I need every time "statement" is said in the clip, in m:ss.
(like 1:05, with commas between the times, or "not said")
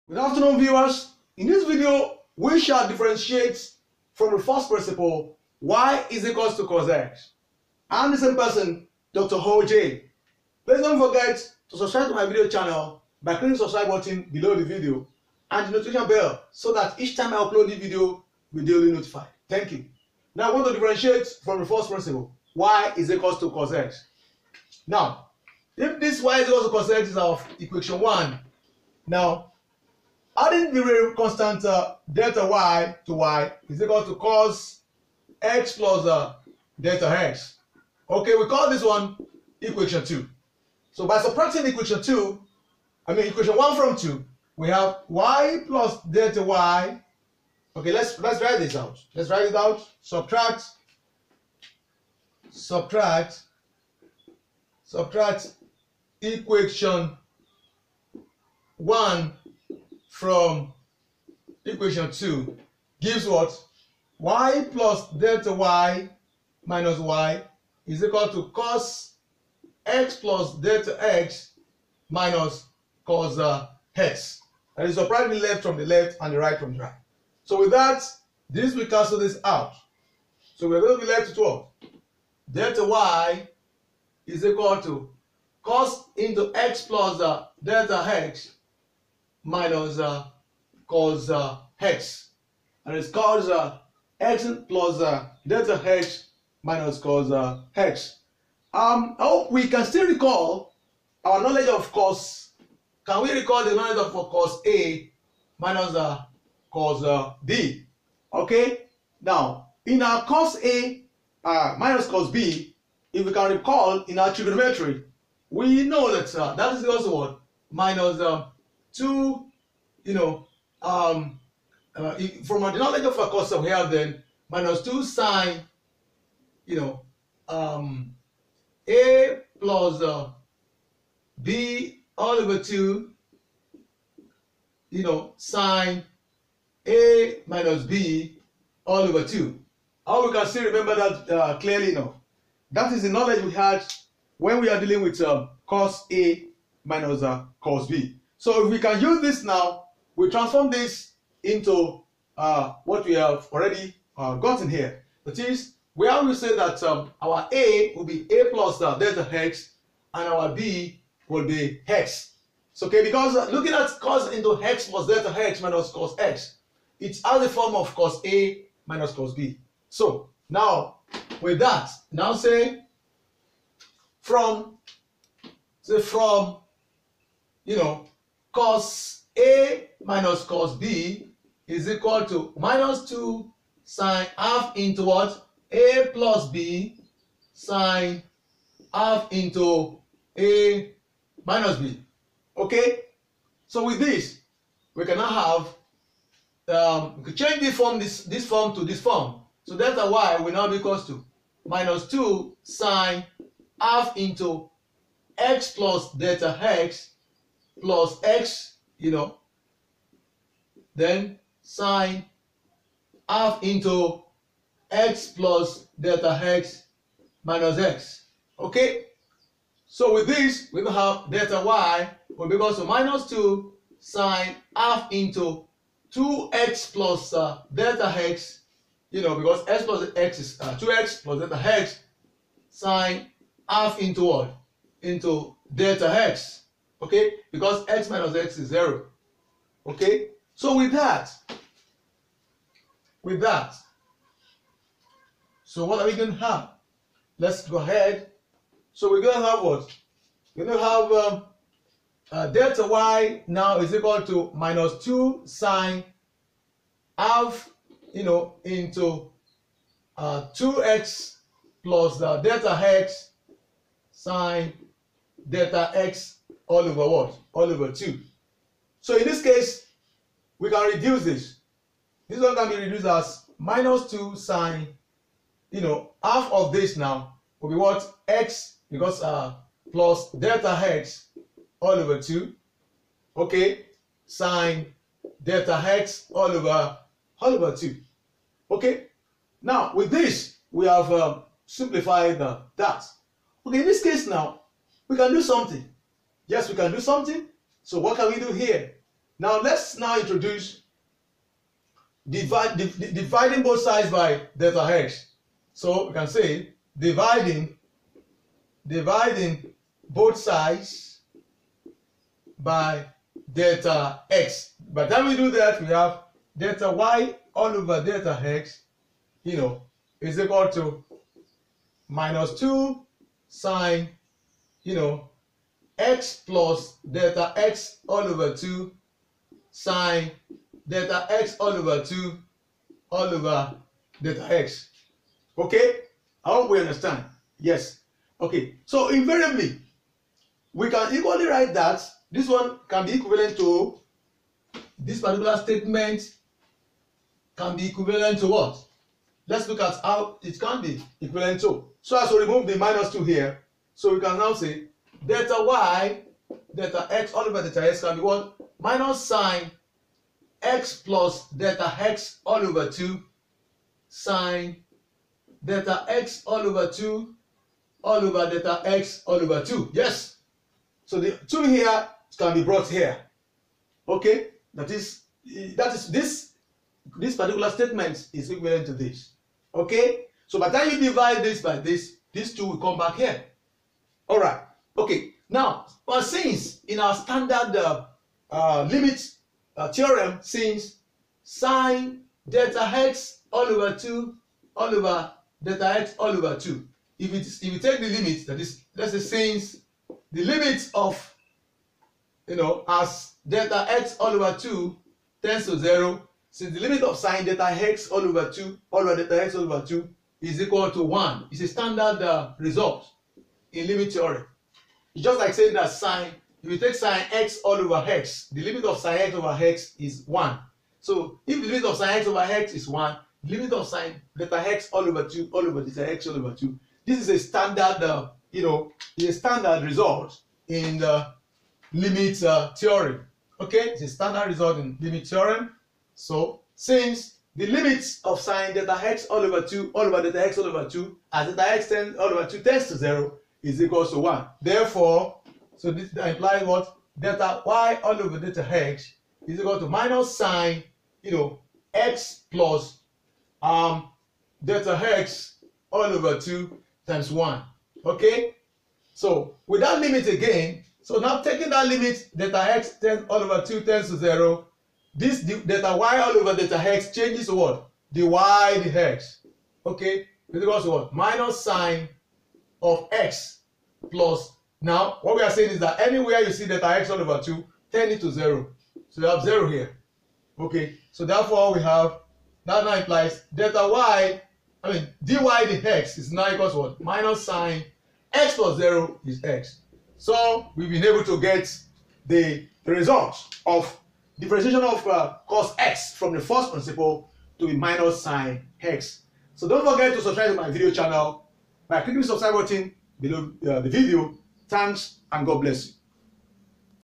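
5:45, 6:17.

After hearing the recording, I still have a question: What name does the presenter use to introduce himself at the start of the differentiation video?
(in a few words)
Dr. OJ.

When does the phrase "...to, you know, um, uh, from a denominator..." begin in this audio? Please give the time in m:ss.
1:58.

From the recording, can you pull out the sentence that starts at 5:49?
Let's look at how it can be equivalent to.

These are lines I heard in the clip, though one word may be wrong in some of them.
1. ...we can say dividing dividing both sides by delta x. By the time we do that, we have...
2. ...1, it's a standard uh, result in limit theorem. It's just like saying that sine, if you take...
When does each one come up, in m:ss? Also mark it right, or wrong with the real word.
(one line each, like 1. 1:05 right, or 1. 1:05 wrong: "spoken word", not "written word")
1. 5:06 right
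2. 6:51 right.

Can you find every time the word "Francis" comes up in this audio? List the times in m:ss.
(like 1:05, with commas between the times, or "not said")
not said.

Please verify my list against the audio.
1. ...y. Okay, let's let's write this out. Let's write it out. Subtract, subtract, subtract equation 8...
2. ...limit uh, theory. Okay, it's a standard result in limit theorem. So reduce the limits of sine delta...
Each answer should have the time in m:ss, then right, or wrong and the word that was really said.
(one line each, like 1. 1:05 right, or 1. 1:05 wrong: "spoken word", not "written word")
1. 0:46 wrong: "1", not "8"
2. 7:11 wrong: "since", not "reduce".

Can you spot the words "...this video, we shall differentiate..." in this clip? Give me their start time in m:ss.
0:01.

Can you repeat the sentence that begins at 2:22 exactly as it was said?
That is the knowledge we had when we are dealing with uh, cos A minus uh, cos B.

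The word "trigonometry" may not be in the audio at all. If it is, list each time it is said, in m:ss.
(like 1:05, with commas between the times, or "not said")
1:54.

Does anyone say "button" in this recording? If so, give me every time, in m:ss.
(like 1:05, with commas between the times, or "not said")
0:13, 8:22.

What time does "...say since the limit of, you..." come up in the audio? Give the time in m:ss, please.
6:39.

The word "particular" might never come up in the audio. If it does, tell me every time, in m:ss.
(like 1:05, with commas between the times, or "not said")
5:45, 6:17.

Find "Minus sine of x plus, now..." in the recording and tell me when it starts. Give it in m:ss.
7:51.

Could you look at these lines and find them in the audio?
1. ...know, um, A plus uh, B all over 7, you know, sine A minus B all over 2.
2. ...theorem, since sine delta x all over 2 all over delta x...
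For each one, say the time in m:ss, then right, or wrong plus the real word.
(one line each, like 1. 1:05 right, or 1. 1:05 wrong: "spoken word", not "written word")
1. 2:06 wrong: "2", not "7"
2. 6:29 right.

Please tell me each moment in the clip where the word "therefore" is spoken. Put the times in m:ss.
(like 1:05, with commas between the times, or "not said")
7:24, 8:01.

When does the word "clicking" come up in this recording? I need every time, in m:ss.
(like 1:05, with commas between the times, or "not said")
0:13, 8:22.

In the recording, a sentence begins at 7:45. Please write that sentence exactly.
This delta y all over delta x changes to what?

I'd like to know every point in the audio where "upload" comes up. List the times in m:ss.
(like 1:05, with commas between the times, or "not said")
0:17.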